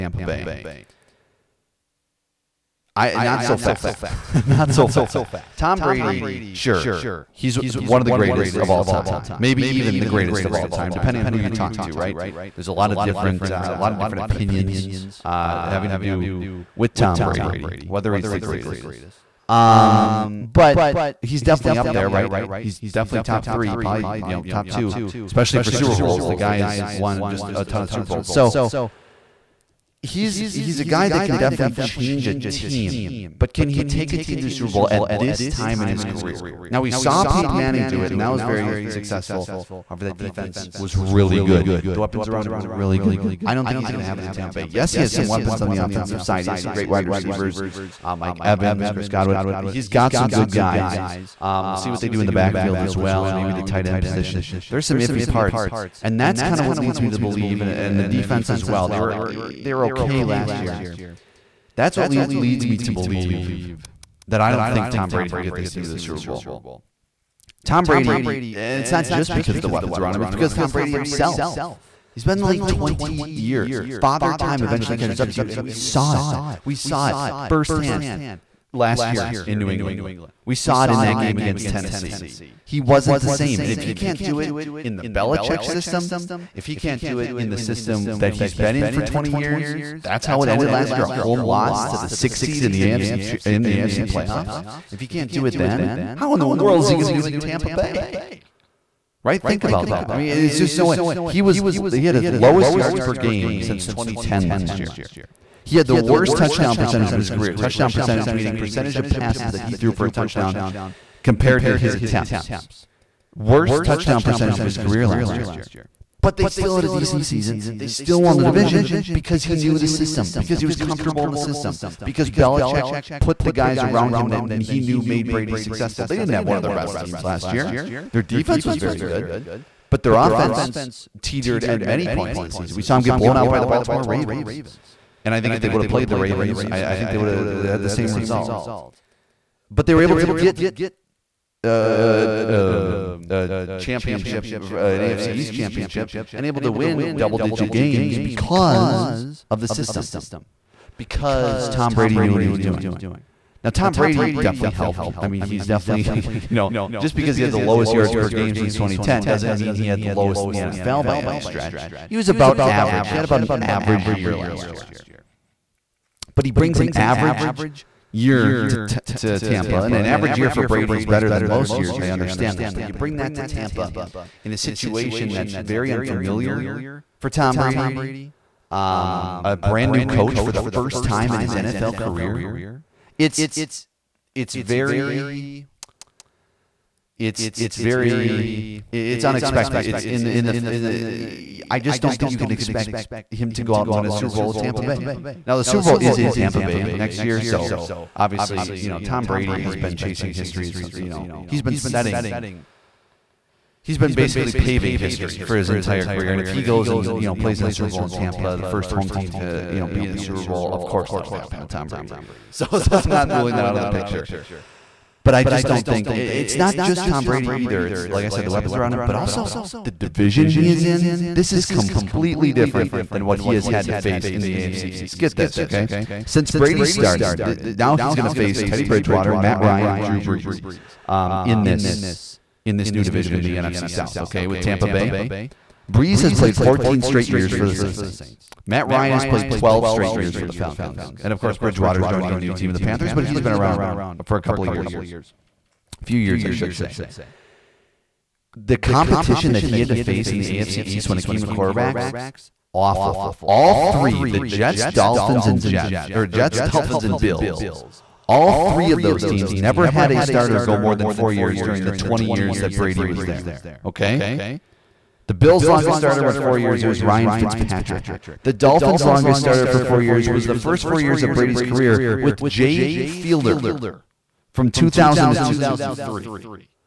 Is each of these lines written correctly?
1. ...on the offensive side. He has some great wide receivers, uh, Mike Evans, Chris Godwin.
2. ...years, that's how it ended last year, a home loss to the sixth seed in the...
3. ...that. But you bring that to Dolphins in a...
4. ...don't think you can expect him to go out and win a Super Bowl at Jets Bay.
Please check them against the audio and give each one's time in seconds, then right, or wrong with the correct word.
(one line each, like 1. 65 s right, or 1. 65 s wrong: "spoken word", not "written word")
1. 45 s right
2. 89 s right
3. 172 s wrong: "Tampa", not "Dolphins"
4. 192 s wrong: "Tampa", not "Jets".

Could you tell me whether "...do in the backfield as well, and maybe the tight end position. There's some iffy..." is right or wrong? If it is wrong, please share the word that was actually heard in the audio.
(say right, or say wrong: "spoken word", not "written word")
right.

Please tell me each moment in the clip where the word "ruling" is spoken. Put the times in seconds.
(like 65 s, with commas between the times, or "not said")
213 s.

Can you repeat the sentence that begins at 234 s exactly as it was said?
Okay, with Tampa Bay, Brees has played 14 straight years for the Saints.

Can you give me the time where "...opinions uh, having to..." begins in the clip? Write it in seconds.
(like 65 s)
14 s.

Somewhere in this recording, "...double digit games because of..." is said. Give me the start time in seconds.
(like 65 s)
147 s.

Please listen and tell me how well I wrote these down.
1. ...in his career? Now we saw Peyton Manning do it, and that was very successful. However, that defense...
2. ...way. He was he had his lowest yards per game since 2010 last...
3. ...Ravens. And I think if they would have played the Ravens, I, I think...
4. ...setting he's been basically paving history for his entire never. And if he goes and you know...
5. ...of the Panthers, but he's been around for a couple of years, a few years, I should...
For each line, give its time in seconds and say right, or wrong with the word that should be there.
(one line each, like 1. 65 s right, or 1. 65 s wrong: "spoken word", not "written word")
1. 35 s right
2. 100 s right
3. 134 s right
4. 201 s wrong: "career", not "never"
5. 242 s right.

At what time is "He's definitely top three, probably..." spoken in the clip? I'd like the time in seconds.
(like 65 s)
22 s.